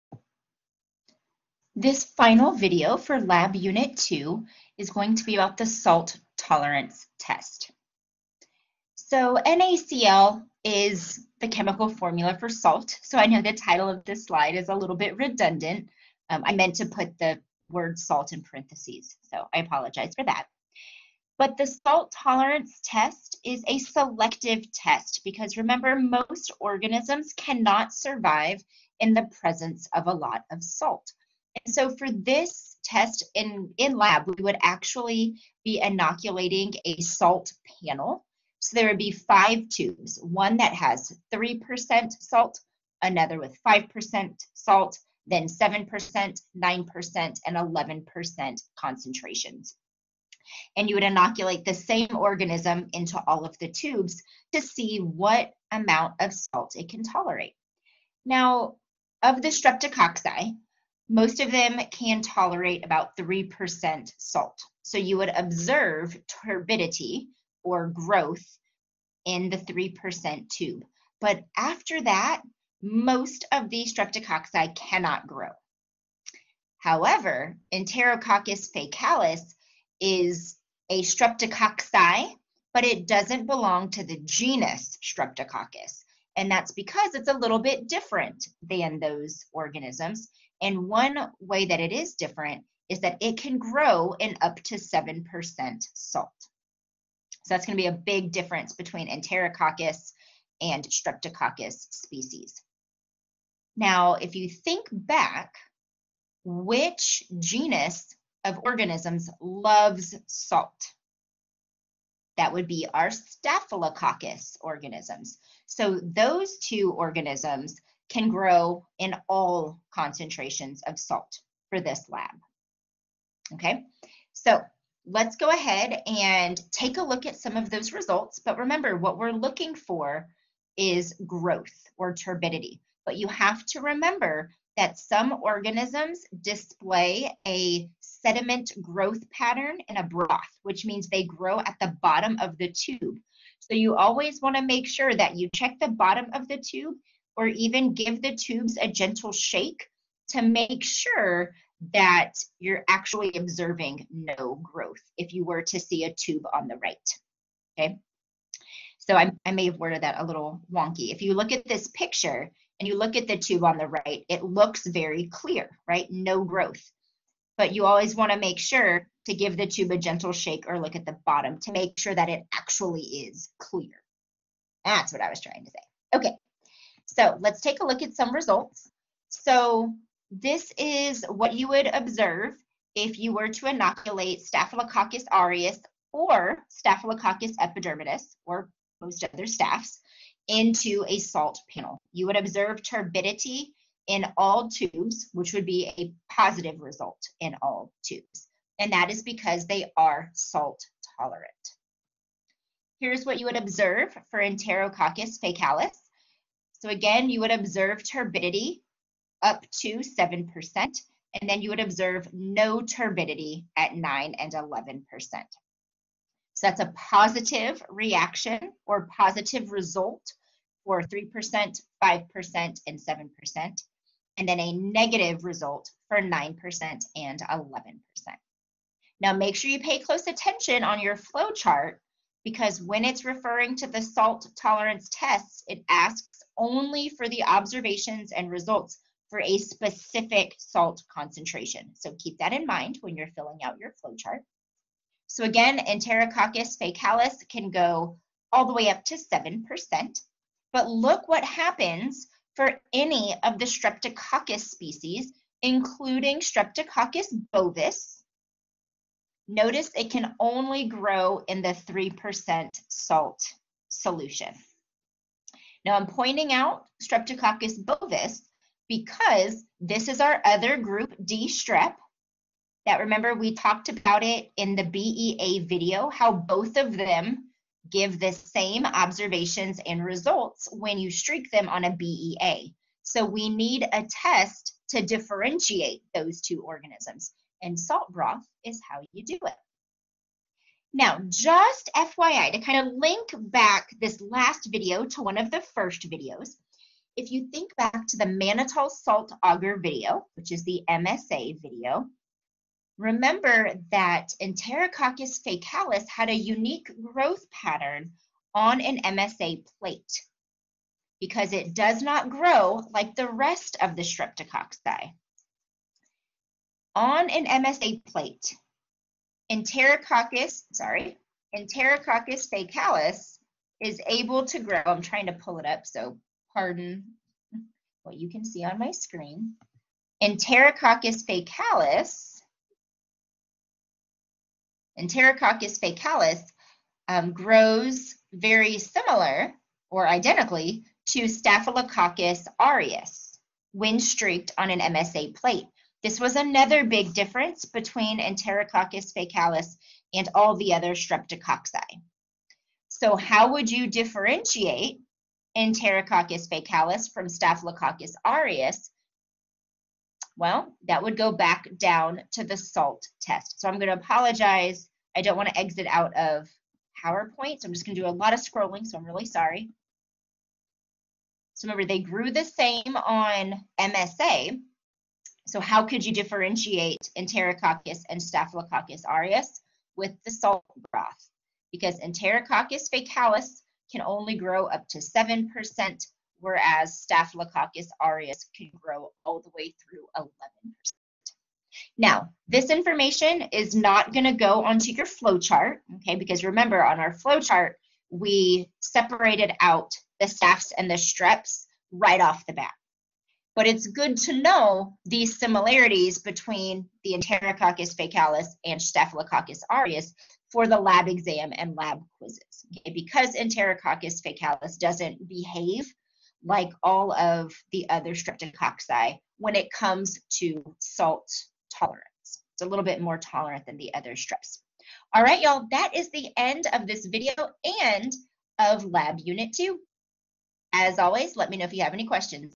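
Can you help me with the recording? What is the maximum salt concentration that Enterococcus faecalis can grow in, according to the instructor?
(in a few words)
7%.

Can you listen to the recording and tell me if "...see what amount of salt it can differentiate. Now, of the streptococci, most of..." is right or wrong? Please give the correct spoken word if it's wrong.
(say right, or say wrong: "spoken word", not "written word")
wrong: "tolerate", not "differentiate".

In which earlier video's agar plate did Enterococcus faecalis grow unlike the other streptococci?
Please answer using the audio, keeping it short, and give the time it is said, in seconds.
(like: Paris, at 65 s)
Mannitol salt agar, at 298 s.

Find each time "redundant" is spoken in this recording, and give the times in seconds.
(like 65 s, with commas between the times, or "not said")
15 s.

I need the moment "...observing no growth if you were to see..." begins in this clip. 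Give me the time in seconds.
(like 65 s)
153 s.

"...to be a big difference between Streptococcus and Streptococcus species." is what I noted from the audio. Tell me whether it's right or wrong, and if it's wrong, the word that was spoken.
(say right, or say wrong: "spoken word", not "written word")
wrong: "Enterococcus", not "Streptococcus".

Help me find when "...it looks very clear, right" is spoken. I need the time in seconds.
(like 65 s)
164 s.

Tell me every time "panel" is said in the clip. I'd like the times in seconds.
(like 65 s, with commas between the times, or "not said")
37 s, 191 s.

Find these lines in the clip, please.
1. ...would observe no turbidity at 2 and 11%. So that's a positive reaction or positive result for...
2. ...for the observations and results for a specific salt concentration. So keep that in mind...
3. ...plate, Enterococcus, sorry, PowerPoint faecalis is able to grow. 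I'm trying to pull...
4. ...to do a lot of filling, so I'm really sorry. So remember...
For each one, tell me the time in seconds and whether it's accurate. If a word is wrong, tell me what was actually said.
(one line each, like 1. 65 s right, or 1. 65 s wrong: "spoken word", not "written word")
1. 211 s wrong: "9", not "2"
2. 237 s right
3. 318 s wrong: "Enterococcus", not "PowerPoint"
4. 367 s wrong: "scrolling", not "filling".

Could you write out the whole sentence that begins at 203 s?
Here's what you would observe for Enterococcus faecalis.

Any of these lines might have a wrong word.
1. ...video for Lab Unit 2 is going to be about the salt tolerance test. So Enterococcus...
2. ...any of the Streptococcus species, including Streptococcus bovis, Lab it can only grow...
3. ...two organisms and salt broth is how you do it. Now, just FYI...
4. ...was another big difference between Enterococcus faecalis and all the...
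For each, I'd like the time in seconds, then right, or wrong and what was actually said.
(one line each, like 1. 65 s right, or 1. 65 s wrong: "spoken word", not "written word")
1. 2 s wrong: "NaCl", not "Enterococcus"
2. 252 s wrong: "Notice", not "Lab"
3. 286 s right
4. 346 s right.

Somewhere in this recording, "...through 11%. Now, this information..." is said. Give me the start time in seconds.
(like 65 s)
389 s.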